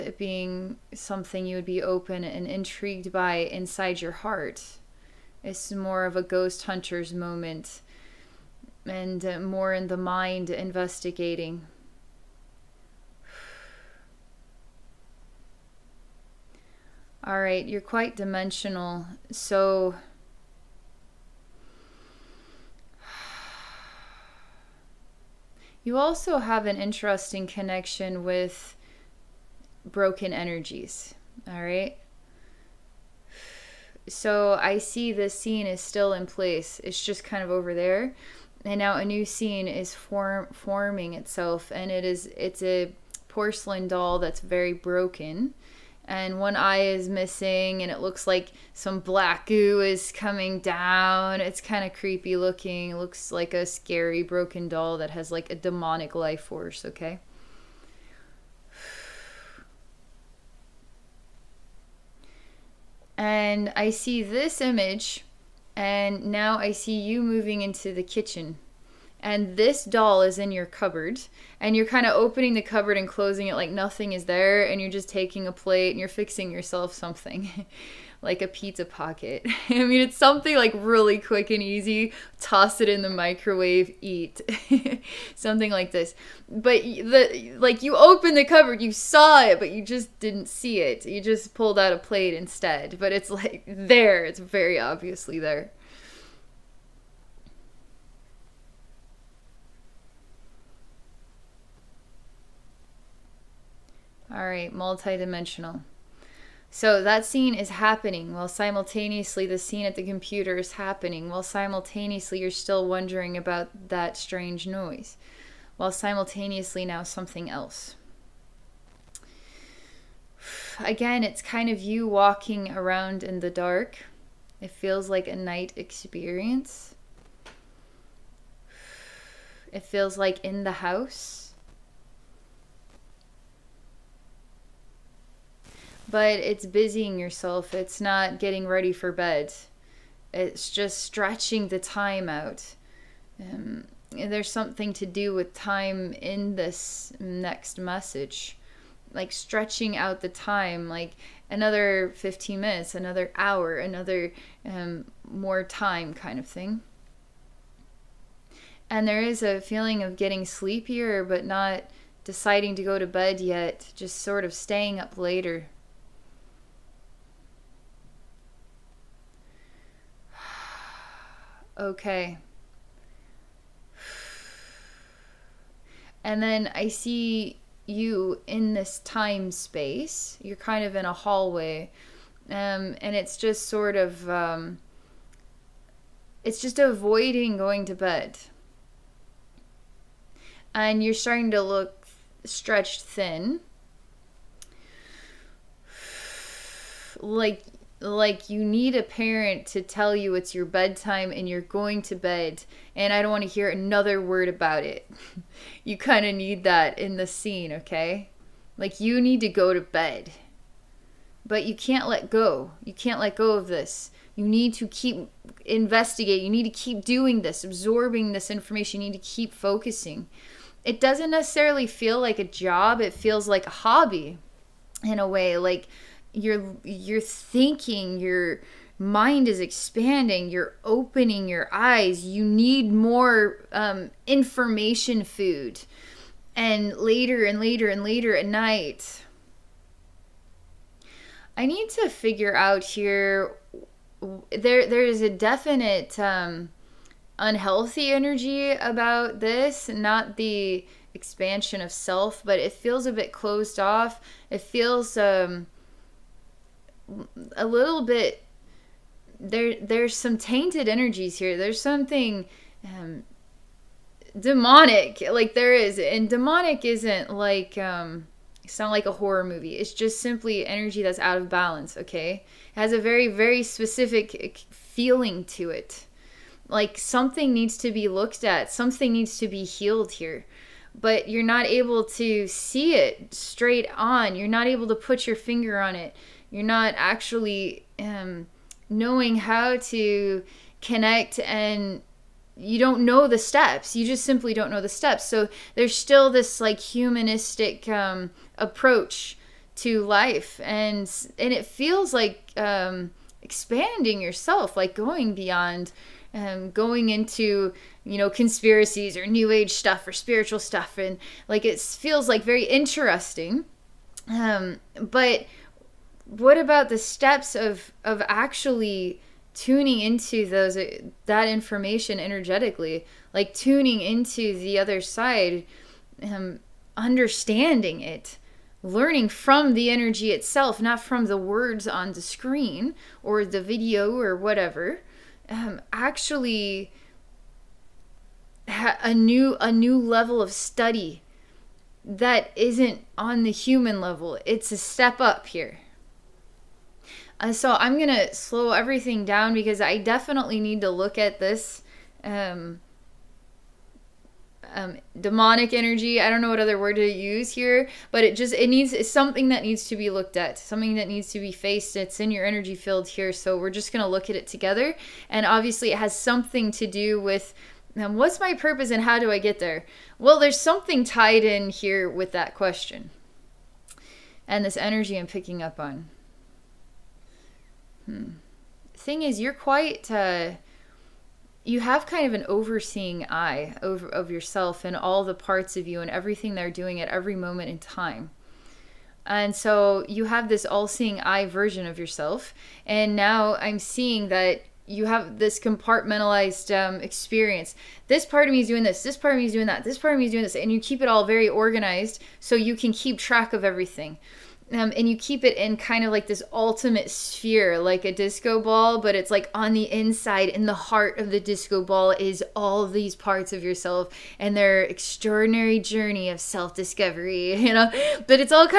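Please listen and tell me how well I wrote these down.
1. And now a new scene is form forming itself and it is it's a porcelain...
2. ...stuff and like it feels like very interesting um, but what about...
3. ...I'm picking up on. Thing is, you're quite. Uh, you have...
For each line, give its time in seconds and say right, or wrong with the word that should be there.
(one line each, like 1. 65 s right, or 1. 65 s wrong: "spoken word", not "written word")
1. 38 s right
2. 310 s right
3. 375 s right.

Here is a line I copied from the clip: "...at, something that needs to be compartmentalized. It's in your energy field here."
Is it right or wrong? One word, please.
wrong.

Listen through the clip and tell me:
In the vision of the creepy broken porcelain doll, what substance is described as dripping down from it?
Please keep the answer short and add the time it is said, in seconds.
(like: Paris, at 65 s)
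black goo, at 48 s.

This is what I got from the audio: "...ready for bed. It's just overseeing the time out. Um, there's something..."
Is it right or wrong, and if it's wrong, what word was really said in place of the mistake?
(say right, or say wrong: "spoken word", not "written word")
wrong: "stretching", not "overseeing".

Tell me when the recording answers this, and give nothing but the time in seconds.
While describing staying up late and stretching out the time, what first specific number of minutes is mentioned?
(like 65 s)
152 s.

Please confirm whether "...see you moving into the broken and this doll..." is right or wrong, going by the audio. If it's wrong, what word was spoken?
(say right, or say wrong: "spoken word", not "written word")
wrong: "kitchen", not "broken".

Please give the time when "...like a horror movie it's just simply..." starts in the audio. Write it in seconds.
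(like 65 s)
268 s.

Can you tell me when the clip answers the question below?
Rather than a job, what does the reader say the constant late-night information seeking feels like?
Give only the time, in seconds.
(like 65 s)
223 s.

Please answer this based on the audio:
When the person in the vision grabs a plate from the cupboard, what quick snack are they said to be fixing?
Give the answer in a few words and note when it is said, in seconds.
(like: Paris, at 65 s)
pizza pocket, at 78 s.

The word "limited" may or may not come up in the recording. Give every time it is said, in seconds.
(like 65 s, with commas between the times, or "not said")
not said.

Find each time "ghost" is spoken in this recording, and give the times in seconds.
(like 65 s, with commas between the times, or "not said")
6 s.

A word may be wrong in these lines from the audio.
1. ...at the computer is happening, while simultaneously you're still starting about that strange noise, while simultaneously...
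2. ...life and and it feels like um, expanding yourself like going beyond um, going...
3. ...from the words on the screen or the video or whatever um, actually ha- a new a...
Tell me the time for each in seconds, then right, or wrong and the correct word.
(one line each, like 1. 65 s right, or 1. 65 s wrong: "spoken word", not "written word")
1. 109 s wrong: "wondering", not "starting"
2. 300 s right
3. 331 s right.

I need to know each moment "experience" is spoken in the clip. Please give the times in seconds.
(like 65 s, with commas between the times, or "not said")
125 s, 397 s.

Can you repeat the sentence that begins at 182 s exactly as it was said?
Um, and it's just sort of, um, it's just avoiding going to bed.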